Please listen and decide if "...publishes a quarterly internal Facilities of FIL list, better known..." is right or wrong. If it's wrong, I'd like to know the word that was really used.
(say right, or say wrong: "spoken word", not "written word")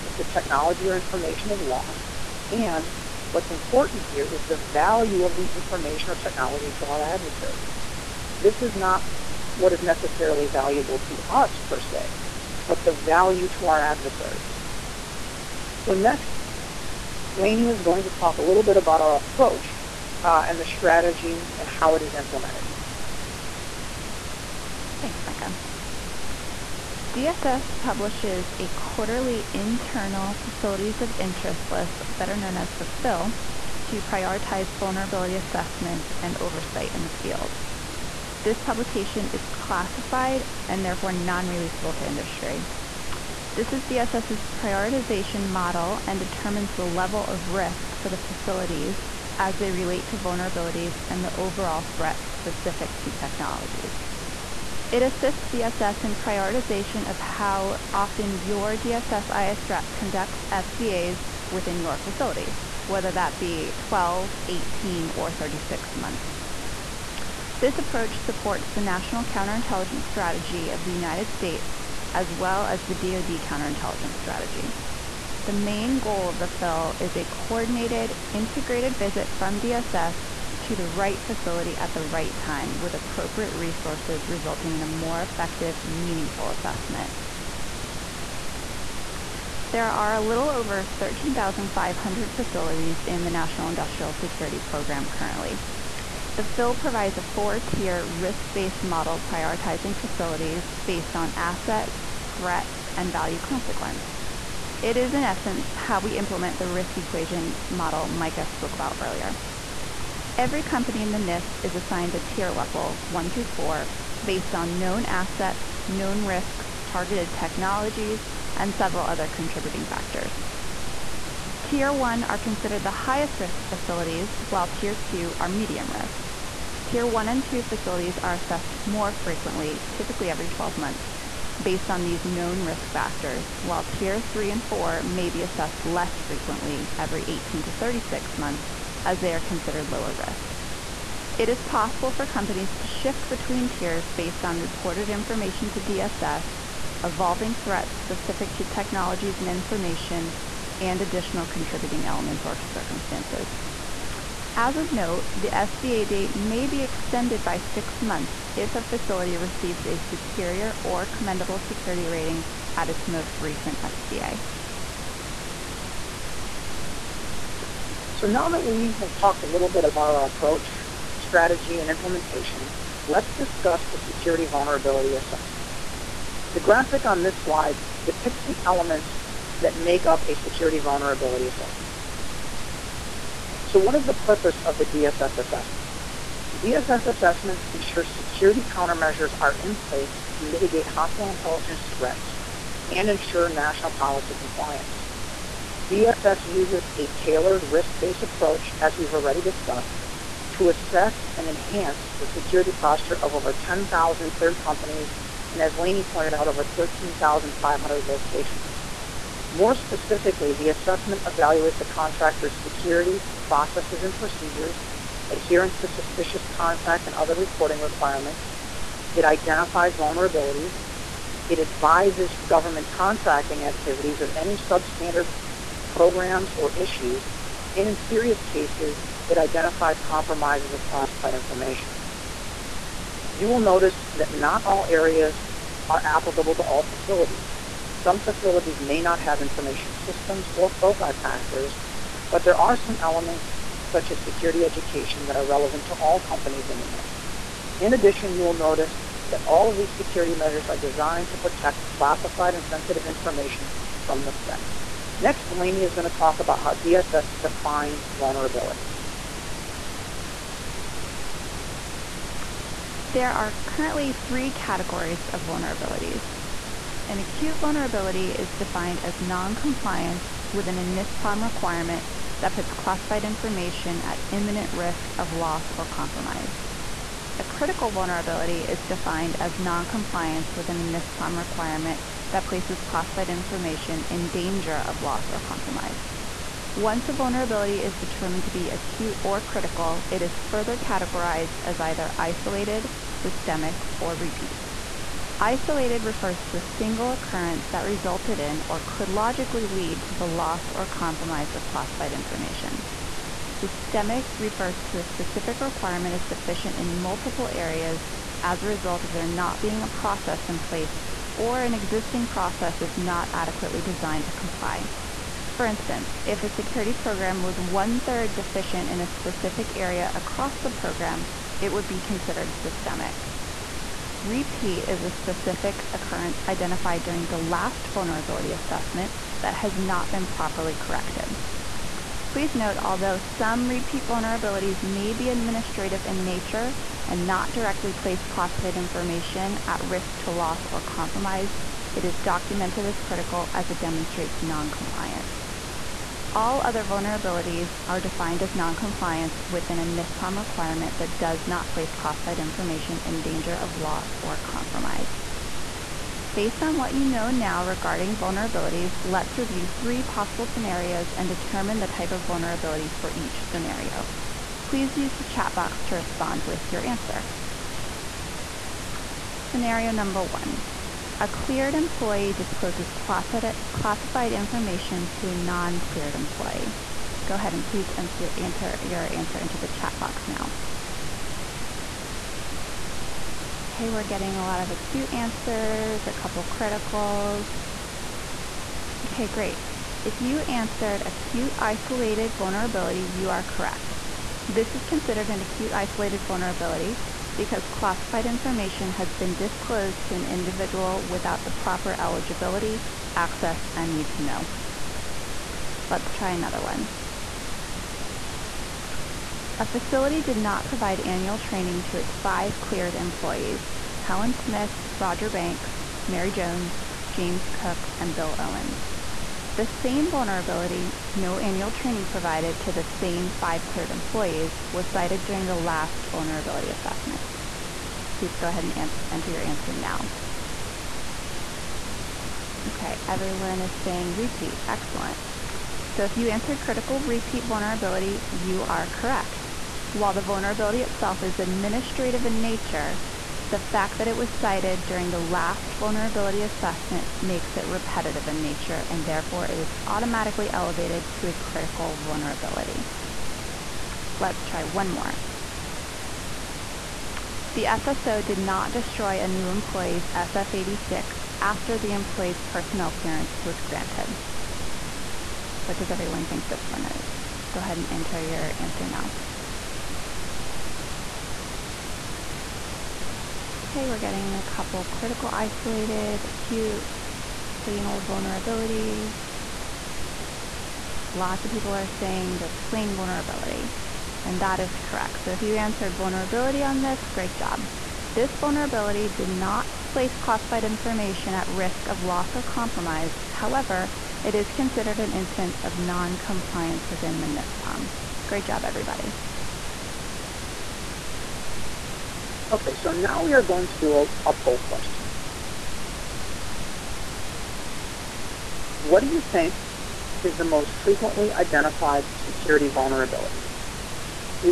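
wrong: "Interest", not "FIL".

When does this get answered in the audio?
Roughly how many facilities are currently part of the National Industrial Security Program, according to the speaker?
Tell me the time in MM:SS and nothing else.
01:30.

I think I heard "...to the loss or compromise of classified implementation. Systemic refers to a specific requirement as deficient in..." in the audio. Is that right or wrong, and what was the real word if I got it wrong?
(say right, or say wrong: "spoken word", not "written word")
wrong: "information", not "implementation".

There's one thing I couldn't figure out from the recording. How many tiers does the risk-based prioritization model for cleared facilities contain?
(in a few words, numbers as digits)
4.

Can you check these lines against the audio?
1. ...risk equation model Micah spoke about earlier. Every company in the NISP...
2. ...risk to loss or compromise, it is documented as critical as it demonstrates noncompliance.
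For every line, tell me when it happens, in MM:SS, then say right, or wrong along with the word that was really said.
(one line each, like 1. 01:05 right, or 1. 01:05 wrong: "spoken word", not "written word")
1. 01:46 right
2. 05:39 right.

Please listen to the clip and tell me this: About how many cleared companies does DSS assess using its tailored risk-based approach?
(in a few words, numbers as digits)
10,000.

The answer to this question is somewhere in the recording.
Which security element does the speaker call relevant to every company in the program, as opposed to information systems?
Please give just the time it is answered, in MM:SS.
04:04.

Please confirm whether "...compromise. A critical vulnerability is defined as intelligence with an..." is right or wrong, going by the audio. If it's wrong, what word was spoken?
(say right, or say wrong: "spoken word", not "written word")
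wrong: "noncompliance", not "intelligence".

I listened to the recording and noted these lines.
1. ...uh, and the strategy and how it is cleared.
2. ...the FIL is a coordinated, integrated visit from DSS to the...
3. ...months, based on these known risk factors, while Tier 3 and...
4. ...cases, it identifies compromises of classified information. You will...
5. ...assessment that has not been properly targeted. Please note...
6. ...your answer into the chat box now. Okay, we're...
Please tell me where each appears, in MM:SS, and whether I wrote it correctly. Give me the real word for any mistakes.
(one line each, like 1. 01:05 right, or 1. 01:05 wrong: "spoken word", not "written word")
1. 00:20 wrong: "implemented", not "cleared"
2. 01:16 right
3. 02:10 right
4. 03:48 right
5. 05:28 wrong: "corrected", not "targeted"
6. 06:18 right.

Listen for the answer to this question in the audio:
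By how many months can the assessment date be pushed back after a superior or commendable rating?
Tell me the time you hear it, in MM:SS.
02:37.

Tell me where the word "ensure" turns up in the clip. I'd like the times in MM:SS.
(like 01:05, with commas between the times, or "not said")
03:07, 03:13.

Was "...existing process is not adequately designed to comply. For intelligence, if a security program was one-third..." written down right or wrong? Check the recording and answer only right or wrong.
wrong.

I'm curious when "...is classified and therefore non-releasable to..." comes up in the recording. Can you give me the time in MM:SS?
00:39.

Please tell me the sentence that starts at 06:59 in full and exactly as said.
The same vulnerability, no annual training provided to the same five cleared employees, was cited during the last vulnerability assessment.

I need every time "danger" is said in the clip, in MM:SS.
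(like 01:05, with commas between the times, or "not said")
04:44, 05:53.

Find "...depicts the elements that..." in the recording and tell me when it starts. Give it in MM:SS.
02:58.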